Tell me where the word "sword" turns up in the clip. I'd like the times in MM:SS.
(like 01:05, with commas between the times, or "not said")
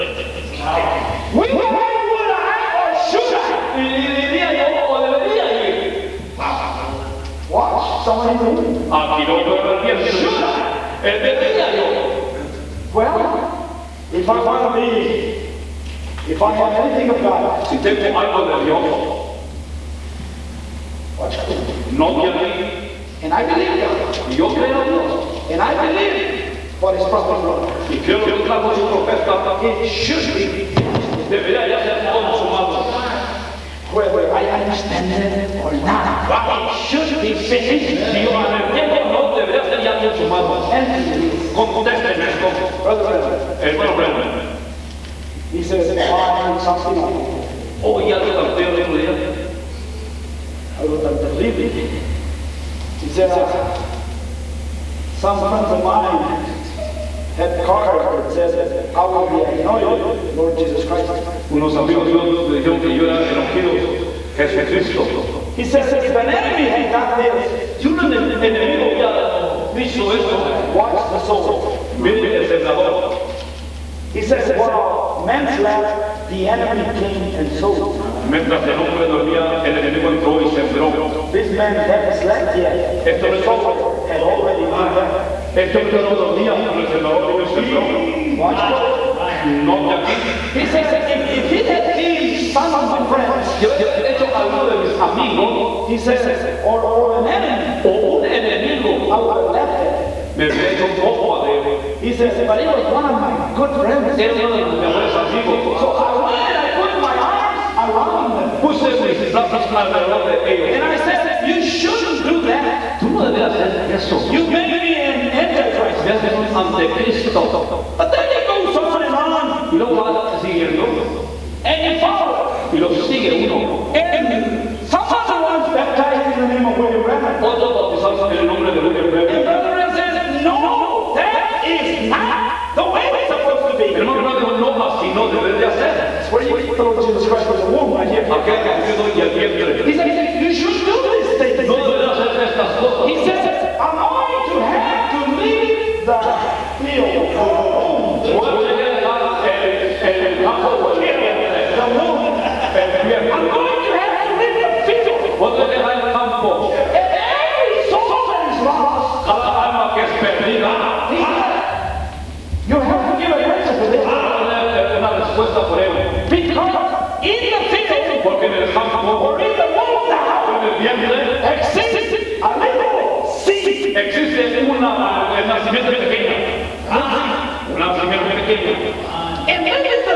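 01:23.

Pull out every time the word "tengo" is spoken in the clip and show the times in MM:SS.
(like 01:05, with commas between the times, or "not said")
00:17.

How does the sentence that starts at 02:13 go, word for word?
El hermano Branham dijo, no, así no debe de hacer.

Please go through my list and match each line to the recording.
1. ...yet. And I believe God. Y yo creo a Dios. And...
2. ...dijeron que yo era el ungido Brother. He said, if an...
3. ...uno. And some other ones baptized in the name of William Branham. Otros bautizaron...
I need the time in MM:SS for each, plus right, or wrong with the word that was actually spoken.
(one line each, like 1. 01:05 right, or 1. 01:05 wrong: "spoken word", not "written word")
1. 00:22 right
2. 01:02 wrong: "Jesucristo", not "Brother"
3. 02:03 right.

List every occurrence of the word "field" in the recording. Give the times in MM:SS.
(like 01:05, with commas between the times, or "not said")
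02:26, 02:34, 02:47.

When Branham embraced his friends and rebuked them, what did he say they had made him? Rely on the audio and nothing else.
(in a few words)
An antichrist.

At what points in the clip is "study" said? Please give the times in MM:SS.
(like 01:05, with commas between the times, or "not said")
not said.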